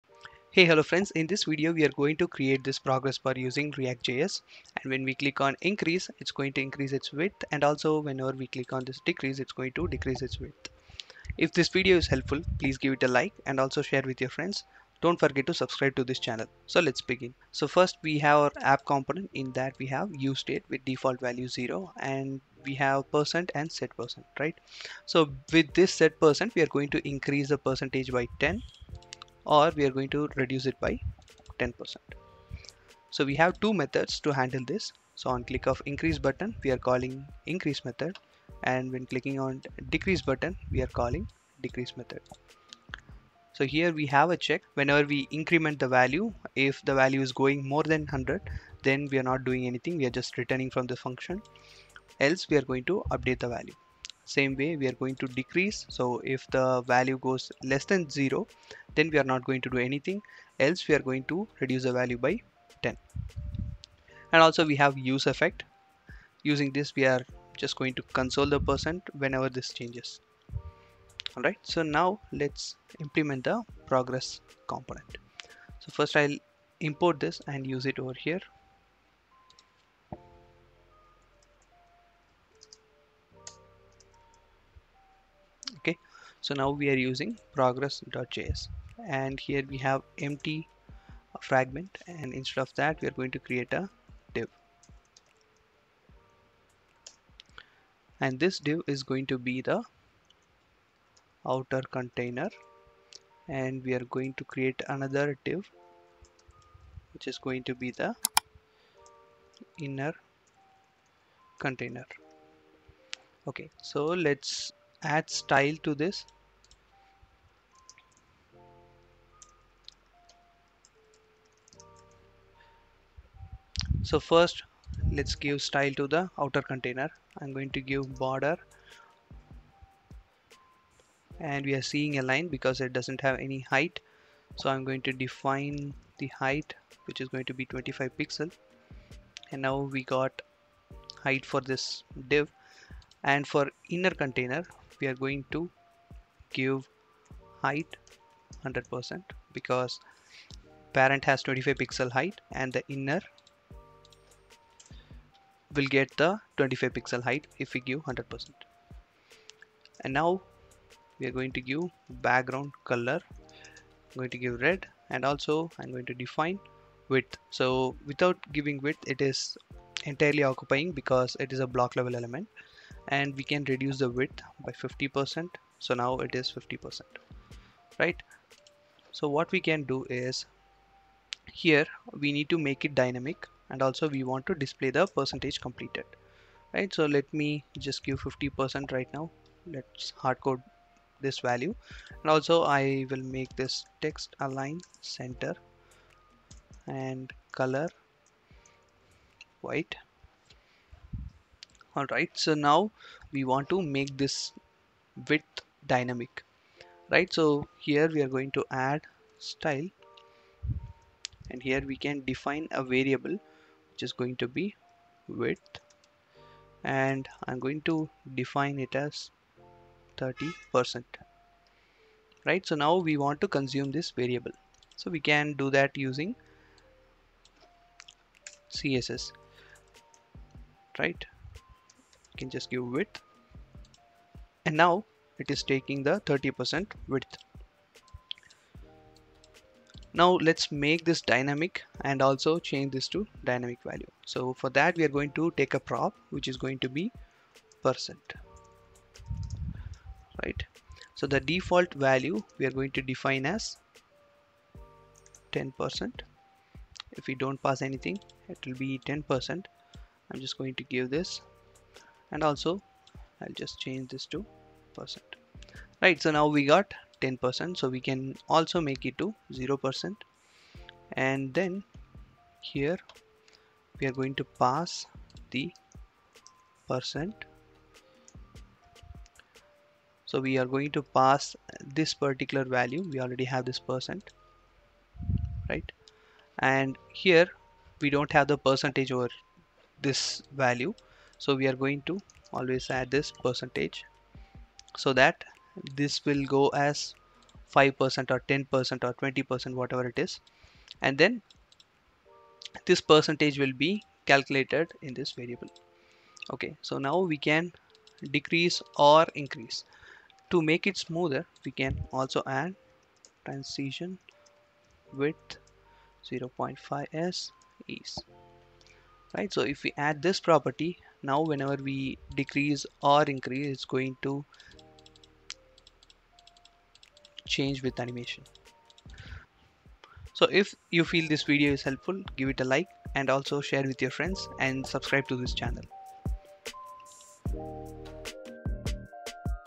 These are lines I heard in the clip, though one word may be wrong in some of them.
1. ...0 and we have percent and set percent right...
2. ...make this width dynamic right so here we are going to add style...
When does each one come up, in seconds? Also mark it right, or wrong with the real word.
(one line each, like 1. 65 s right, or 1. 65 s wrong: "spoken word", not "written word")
1. 21 s right
2. 203 s right.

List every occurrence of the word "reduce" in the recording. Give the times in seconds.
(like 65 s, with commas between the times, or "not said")
30 s, 61 s, 173 s.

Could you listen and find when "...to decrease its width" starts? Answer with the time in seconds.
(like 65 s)
9 s.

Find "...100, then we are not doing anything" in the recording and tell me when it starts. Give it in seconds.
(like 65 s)
48 s.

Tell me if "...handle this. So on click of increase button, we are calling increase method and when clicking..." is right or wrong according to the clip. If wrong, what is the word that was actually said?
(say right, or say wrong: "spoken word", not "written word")
right.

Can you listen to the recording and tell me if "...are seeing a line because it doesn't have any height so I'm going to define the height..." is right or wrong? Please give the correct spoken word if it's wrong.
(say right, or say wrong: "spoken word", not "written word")
right.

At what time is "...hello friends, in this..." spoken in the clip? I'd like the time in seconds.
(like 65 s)
0 s.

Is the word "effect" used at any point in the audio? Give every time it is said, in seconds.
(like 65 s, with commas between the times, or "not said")
65 s.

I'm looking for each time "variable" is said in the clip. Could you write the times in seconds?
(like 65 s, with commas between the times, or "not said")
212 s, 224 s, 305 s.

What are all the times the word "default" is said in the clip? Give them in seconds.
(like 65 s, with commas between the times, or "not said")
20 s, 251 s.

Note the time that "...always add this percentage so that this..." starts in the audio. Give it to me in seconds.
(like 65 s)
292 s.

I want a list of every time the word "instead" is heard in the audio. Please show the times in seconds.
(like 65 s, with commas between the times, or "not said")
92 s.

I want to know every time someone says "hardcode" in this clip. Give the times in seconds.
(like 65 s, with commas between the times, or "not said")
190 s.